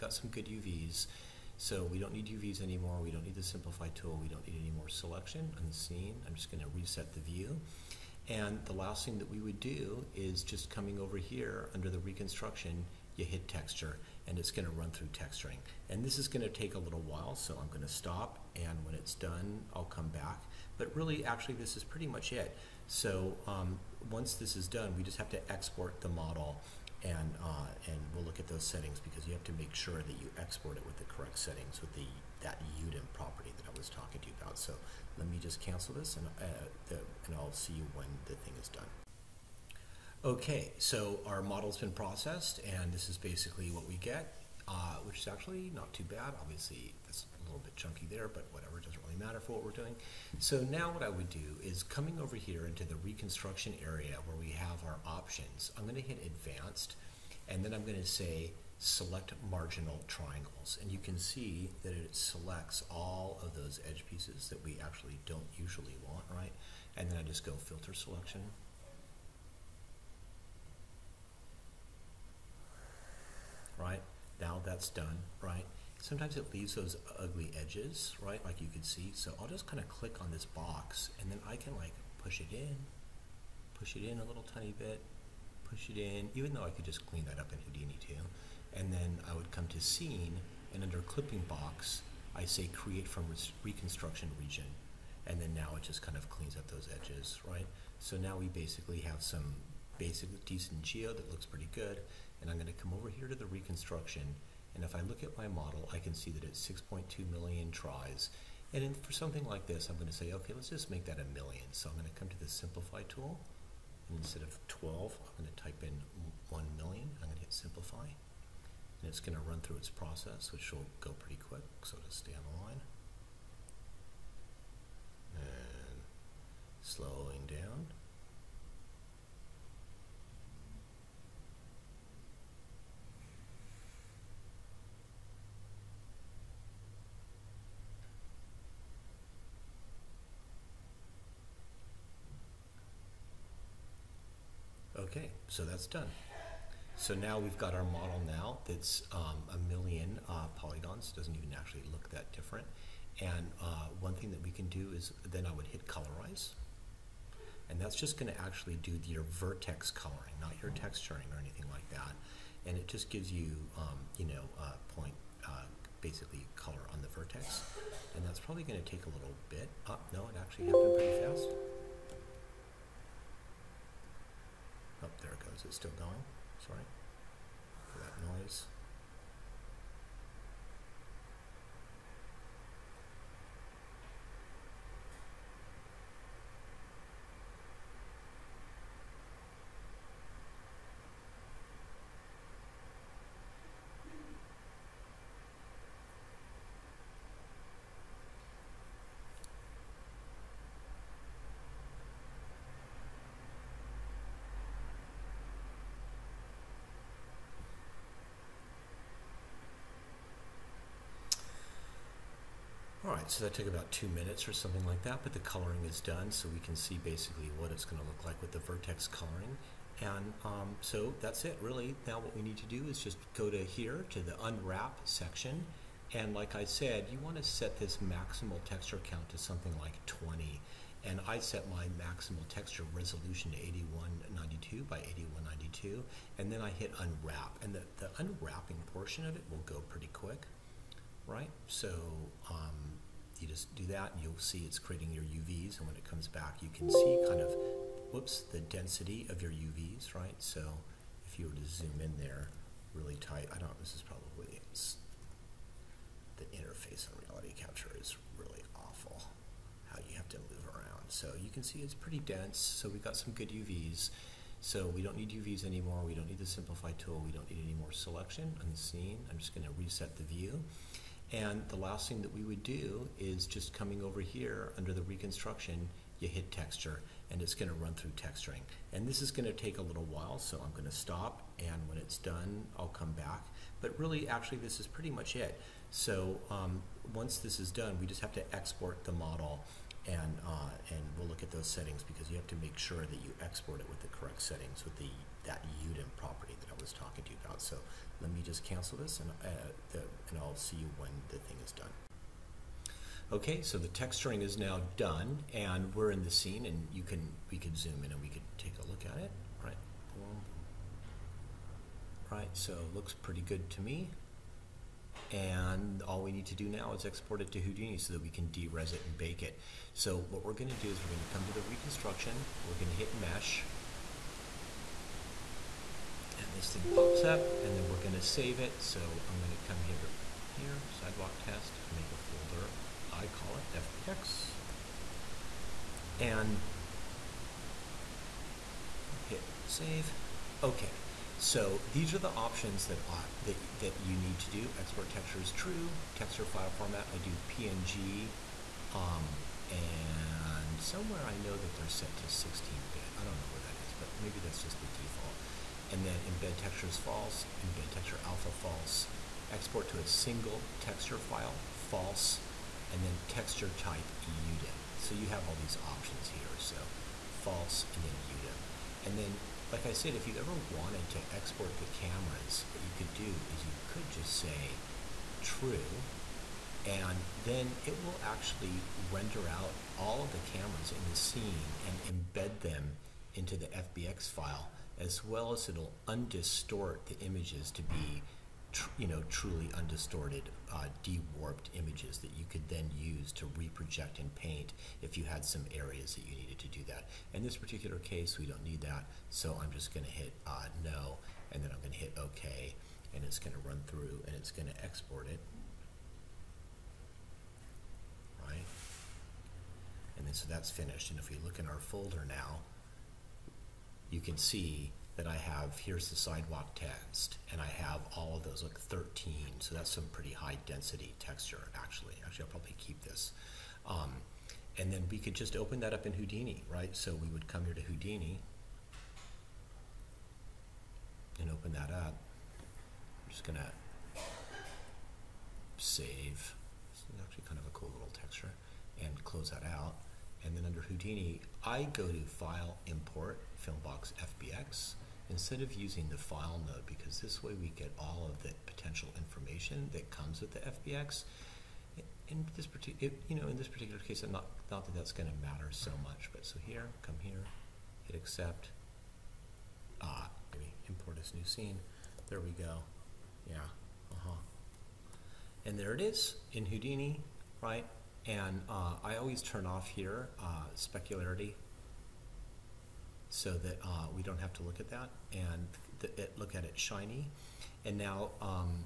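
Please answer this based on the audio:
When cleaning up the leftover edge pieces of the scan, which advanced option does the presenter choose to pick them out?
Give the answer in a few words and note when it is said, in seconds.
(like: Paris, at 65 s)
select marginal triangles, at 58 s.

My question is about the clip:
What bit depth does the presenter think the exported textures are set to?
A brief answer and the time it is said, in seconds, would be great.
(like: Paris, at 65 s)
16-bit, at 352 s.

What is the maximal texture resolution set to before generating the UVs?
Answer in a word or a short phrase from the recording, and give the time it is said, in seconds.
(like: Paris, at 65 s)
8192 by 8192, at 233 s.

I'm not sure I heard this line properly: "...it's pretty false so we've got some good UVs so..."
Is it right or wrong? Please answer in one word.
wrong.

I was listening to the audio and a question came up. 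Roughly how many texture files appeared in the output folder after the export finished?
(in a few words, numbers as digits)
13.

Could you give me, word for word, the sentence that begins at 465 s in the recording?
And there it is in Houdini, right?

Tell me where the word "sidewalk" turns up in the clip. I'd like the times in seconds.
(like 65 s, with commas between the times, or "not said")
330 s, 416 s.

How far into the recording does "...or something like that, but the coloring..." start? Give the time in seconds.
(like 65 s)
214 s.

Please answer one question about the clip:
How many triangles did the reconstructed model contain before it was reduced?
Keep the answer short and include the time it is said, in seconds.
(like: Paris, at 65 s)
6.2 million, at 106 s.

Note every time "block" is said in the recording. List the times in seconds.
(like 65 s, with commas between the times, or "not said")
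not said.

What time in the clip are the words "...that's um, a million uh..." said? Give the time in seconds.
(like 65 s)
148 s.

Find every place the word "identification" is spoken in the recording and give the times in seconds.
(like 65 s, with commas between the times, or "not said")
not said.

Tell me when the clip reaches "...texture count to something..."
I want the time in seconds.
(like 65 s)
228 s.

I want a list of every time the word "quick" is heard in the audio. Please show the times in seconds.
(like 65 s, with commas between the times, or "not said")
121 s, 240 s.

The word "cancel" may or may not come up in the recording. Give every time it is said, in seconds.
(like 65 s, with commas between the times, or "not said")
35 s, 298 s.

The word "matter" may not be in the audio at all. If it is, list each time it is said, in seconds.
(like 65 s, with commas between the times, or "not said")
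49 s, 455 s.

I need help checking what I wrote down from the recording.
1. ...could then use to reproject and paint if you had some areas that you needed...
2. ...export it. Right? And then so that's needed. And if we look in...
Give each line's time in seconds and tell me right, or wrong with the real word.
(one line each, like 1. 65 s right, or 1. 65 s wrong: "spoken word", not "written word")
1. 392 s right
2. 404 s wrong: "finished", not "needed".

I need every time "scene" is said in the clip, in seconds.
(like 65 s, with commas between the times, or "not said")
5 s, 89 s, 268 s, 306 s, 381 s, 461 s.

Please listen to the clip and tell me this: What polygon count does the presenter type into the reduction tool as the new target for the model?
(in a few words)
1 million.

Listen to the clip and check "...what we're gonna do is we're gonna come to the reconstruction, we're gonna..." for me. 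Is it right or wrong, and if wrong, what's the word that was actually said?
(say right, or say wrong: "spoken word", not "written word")
right.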